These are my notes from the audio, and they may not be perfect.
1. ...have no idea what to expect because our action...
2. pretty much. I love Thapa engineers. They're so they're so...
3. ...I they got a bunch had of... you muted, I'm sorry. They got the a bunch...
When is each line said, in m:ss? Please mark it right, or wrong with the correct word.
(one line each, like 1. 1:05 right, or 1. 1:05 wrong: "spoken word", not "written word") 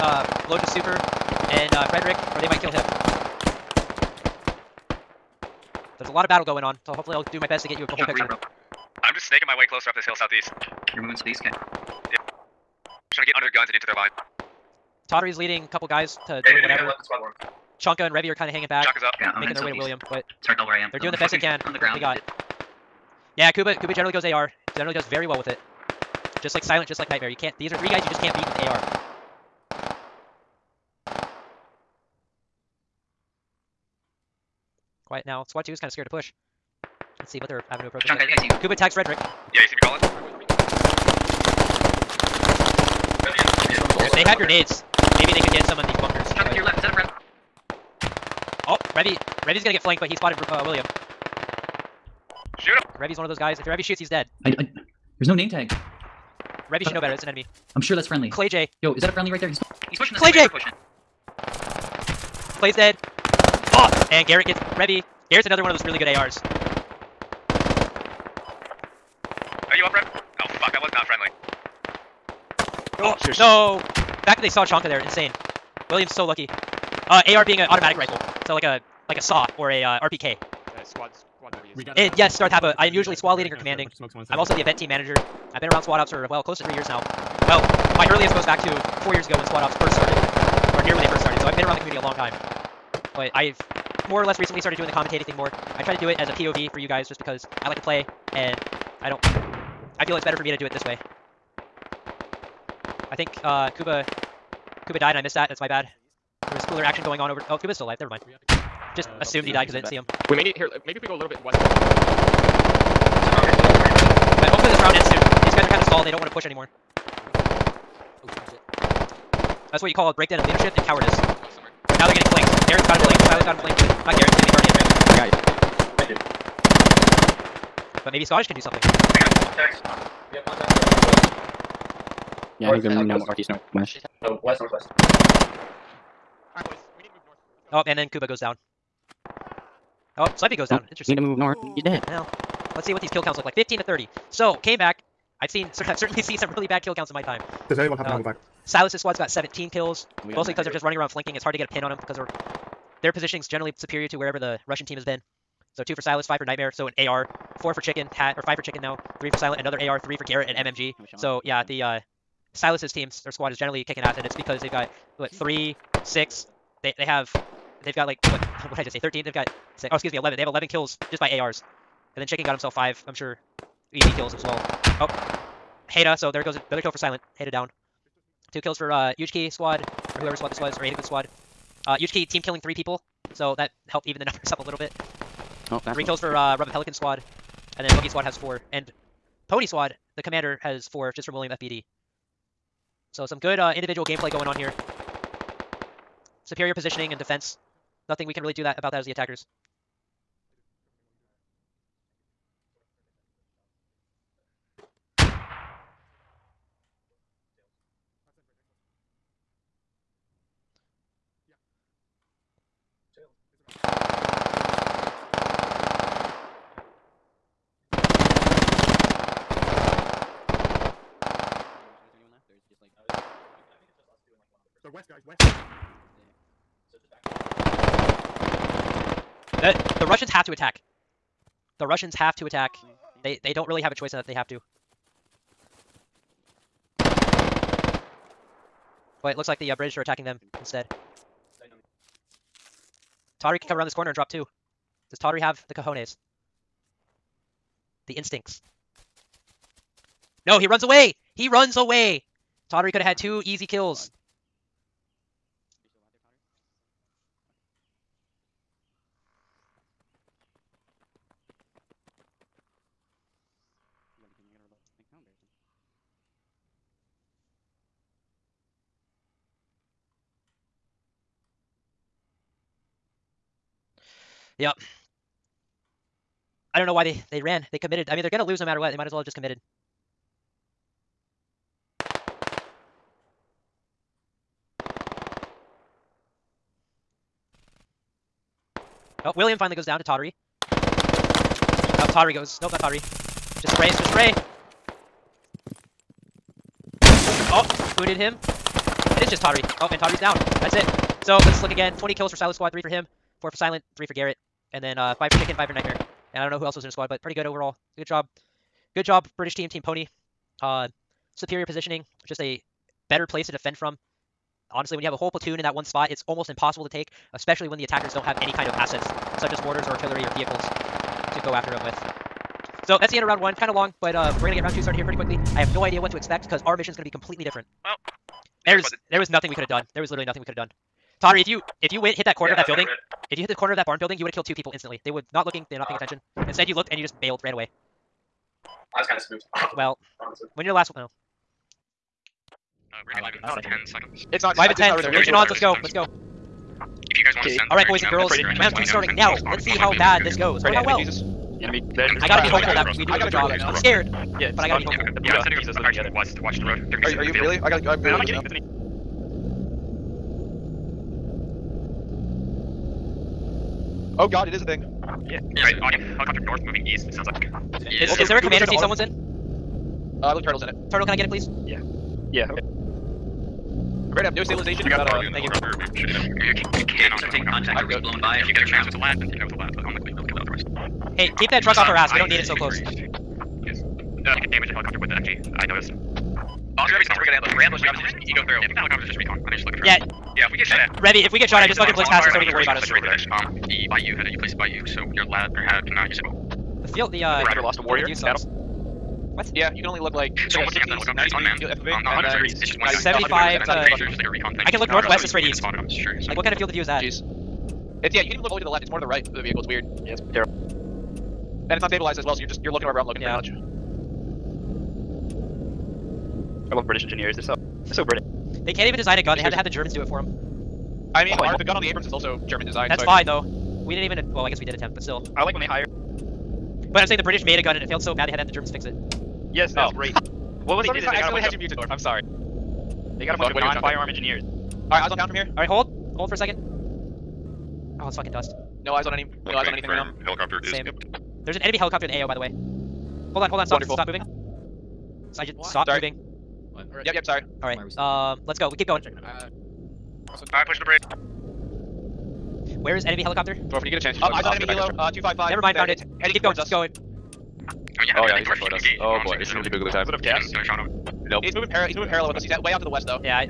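1. 5:25 wrong: "mission", not "action"
2. 6:53 wrong: "British", not "Thapa"
3. 7:11 right.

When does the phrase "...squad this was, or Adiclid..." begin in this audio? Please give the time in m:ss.
3:00.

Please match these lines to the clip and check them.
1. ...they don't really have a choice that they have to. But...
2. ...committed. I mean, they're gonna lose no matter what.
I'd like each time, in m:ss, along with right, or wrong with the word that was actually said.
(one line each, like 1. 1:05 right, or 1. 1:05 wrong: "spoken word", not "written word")
1. 3:53 right
2. 4:37 right.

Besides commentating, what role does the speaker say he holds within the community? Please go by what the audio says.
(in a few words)
event team manager.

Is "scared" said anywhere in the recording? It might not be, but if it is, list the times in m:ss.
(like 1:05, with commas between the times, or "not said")
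0:35, 5:53.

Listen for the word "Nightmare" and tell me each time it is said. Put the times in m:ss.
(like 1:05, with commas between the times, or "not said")
0:27, 2:36, 5:05.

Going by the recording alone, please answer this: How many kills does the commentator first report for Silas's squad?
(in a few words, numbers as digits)
17.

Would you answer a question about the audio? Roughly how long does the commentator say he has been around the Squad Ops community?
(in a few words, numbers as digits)
close to 3 years.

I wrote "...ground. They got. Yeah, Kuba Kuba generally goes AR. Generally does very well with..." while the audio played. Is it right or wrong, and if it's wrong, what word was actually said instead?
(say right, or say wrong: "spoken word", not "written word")
right.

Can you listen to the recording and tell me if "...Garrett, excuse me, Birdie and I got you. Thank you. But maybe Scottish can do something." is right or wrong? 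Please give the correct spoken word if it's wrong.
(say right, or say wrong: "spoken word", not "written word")
right.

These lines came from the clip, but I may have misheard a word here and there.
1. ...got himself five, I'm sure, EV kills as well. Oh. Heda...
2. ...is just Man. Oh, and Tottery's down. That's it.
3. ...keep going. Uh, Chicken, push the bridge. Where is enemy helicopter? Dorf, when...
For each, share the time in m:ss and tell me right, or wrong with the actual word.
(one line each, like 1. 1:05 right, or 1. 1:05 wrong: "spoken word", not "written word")
1. 2:52 right
2. 4:59 wrong: "Tottery", not "Man"
3. 7:28 wrong: "Alright", not "Chicken".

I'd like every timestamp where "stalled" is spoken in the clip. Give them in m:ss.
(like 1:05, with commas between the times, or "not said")
1:55.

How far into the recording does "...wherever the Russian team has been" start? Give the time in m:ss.
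2:34.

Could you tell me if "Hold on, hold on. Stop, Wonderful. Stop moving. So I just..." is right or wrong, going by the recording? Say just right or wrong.
right.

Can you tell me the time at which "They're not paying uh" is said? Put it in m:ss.
5:35.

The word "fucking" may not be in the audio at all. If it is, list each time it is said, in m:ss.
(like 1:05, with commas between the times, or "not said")
6:31, 7:18.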